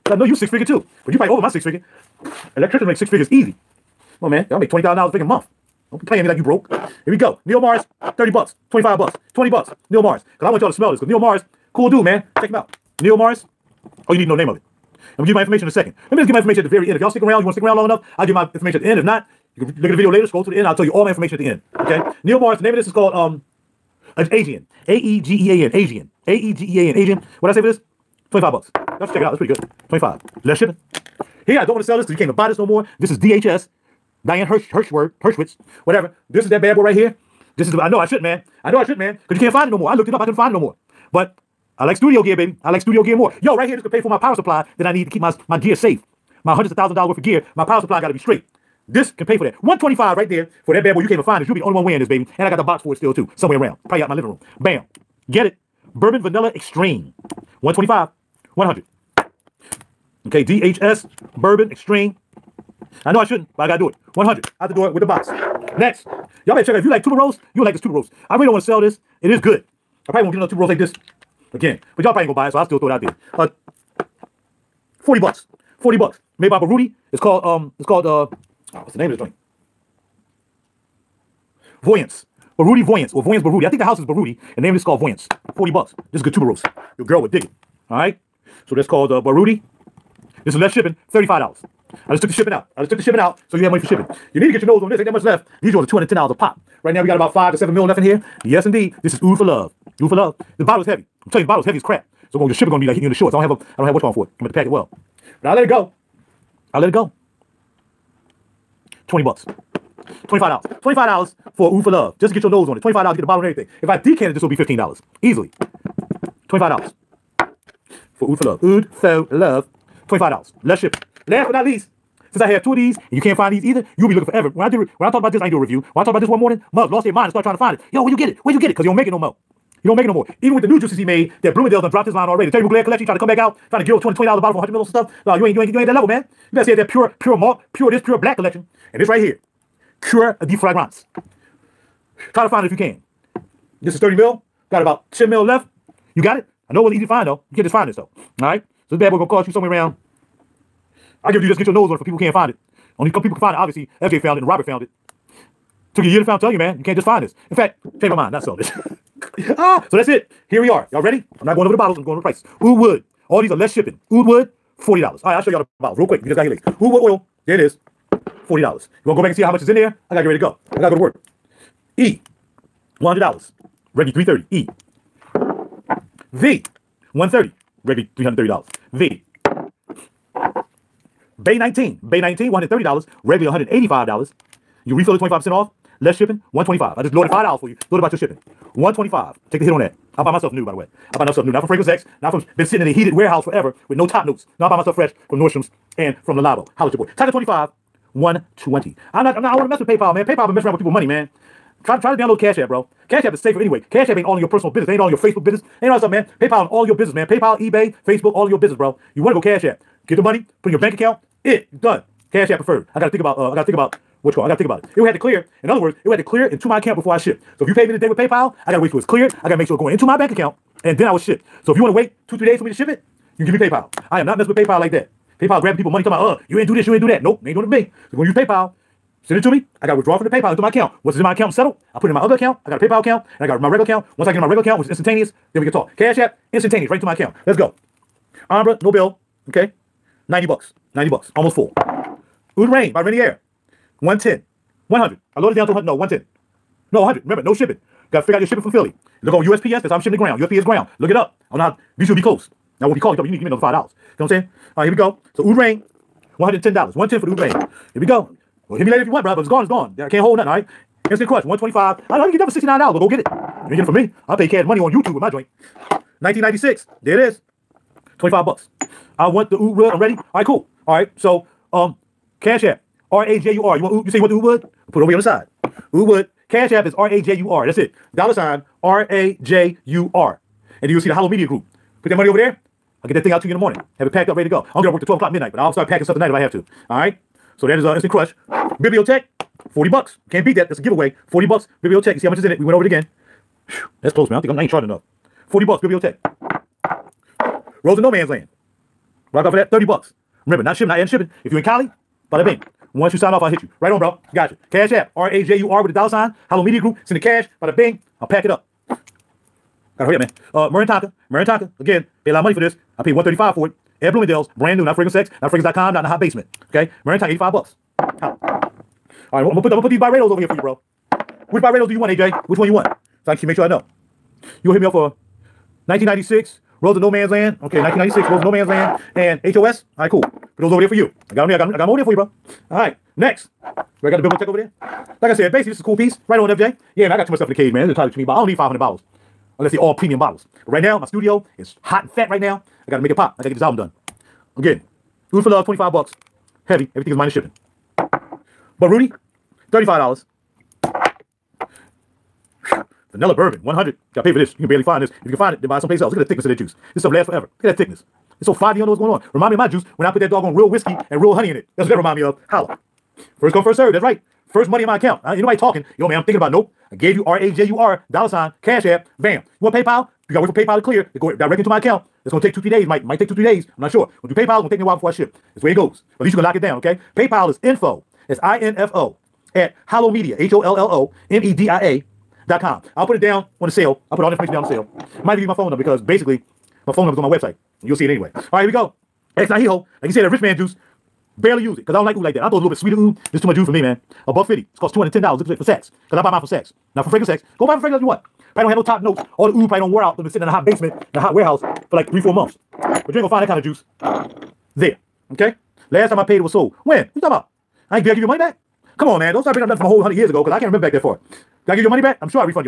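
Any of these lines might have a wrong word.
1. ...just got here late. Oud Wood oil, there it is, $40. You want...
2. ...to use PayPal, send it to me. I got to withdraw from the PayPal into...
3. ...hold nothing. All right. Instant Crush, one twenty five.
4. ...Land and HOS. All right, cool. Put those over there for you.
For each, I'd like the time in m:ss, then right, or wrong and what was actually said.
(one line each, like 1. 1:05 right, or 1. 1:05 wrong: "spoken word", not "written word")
1. 2:46 right
2. 3:48 right
3. 4:20 right
4. 5:28 right.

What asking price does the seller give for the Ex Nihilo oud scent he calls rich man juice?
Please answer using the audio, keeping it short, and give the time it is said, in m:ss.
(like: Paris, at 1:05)
$150, at 6:34.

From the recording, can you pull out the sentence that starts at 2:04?
When I did when I talked about this, I ain't do a review.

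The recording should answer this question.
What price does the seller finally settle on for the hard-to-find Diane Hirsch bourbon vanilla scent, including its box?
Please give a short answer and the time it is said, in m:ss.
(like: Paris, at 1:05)
$100, at 1:04.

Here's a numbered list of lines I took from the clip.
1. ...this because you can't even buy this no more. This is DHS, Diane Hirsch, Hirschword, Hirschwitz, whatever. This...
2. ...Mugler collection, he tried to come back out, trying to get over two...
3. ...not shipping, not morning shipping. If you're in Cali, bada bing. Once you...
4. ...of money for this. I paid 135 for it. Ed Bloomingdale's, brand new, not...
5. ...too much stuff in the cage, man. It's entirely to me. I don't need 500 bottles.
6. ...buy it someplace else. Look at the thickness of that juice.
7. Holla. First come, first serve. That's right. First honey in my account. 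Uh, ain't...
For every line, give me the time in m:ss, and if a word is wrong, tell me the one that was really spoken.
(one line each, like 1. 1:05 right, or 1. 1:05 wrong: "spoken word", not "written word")
1. 0:31 right
2. 2:12 right
3. 5:00 wrong: "adding", not "morning"
4. 5:12 right
5. 5:37 right
6. 5:55 right
7. 6:02 wrong: "money", not "honey".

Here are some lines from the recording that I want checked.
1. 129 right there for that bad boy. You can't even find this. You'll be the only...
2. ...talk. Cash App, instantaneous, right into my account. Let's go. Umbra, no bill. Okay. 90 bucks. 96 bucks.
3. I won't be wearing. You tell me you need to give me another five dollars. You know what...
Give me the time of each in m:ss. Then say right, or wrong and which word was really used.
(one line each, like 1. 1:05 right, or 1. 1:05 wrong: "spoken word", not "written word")
1. 0:49 wrong: "125", not "129"
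2. 3:55 wrong: "90", not "96"
3. 4:12 wrong: "calling", not "wearing".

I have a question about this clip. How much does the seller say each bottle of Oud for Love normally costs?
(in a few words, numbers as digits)
$210.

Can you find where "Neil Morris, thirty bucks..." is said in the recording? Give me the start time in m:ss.
0:07.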